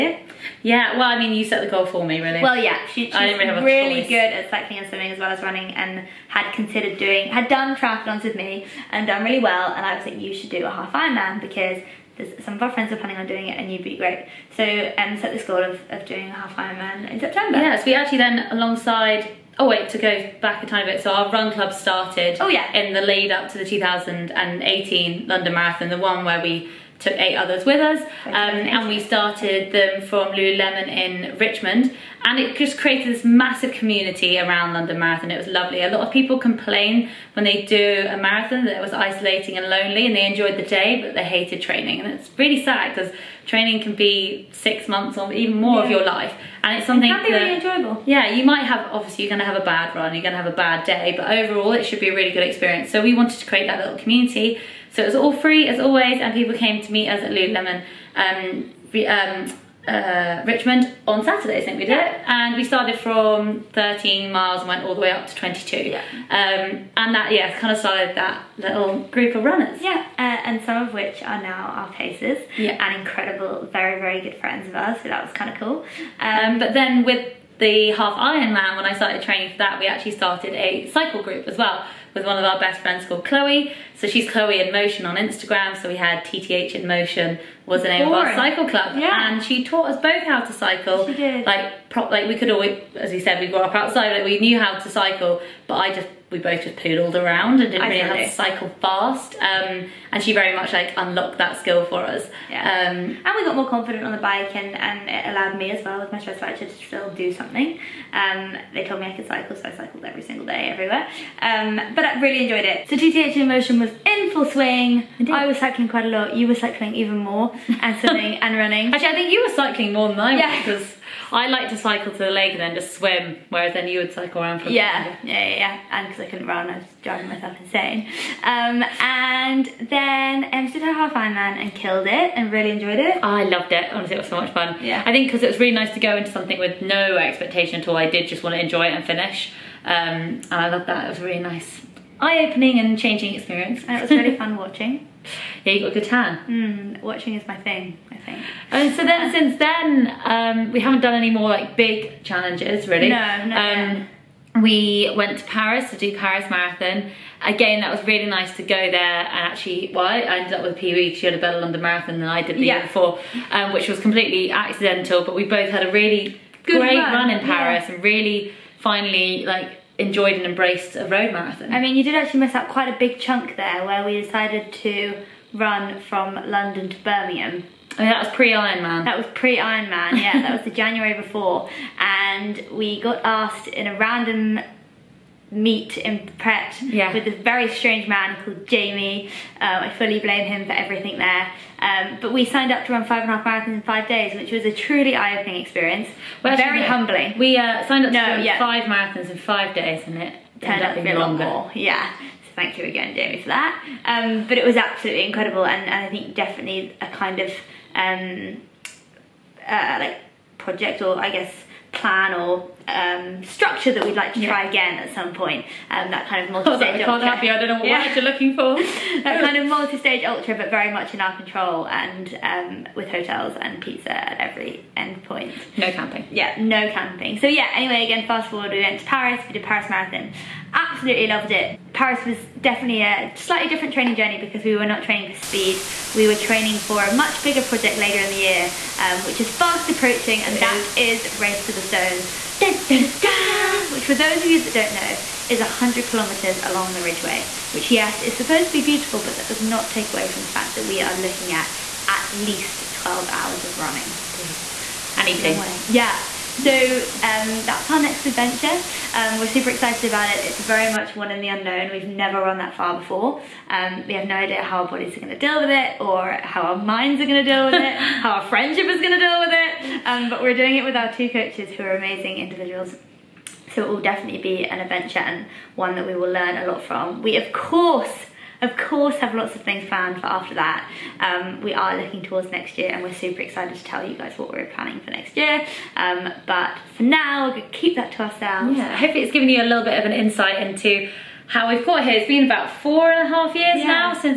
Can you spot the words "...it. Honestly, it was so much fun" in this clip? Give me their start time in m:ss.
2:13.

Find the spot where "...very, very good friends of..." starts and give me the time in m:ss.
1:13.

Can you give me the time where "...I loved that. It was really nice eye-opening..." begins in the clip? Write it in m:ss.
2:20.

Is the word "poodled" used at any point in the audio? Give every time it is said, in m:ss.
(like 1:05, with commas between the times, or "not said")
1:36.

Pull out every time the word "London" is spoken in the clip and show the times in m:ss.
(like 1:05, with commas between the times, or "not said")
0:25, 0:34, 2:41, 2:56.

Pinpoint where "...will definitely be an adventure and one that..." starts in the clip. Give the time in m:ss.
4:33.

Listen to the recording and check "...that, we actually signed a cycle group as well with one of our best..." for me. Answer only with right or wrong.
wrong.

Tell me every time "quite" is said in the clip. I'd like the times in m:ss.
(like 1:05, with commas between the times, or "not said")
1:55, 2:52.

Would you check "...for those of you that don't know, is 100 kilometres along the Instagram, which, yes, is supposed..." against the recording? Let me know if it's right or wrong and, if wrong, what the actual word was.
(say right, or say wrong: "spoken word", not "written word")
wrong: "Ridgeway", not "Instagram".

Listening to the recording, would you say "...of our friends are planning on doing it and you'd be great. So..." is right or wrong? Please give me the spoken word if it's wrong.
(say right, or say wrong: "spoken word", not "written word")
right.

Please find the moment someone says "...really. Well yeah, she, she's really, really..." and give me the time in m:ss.
0:02.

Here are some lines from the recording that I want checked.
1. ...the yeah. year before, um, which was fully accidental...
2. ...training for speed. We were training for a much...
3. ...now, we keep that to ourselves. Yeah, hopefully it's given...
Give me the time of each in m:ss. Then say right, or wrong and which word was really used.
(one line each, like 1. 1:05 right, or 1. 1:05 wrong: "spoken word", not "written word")
1. 2:42 wrong: "completely", not "fully"
2. 3:55 right
3. 4:47 right.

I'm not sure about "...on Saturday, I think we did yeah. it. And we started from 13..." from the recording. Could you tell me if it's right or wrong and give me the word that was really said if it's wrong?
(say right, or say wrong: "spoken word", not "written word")
right.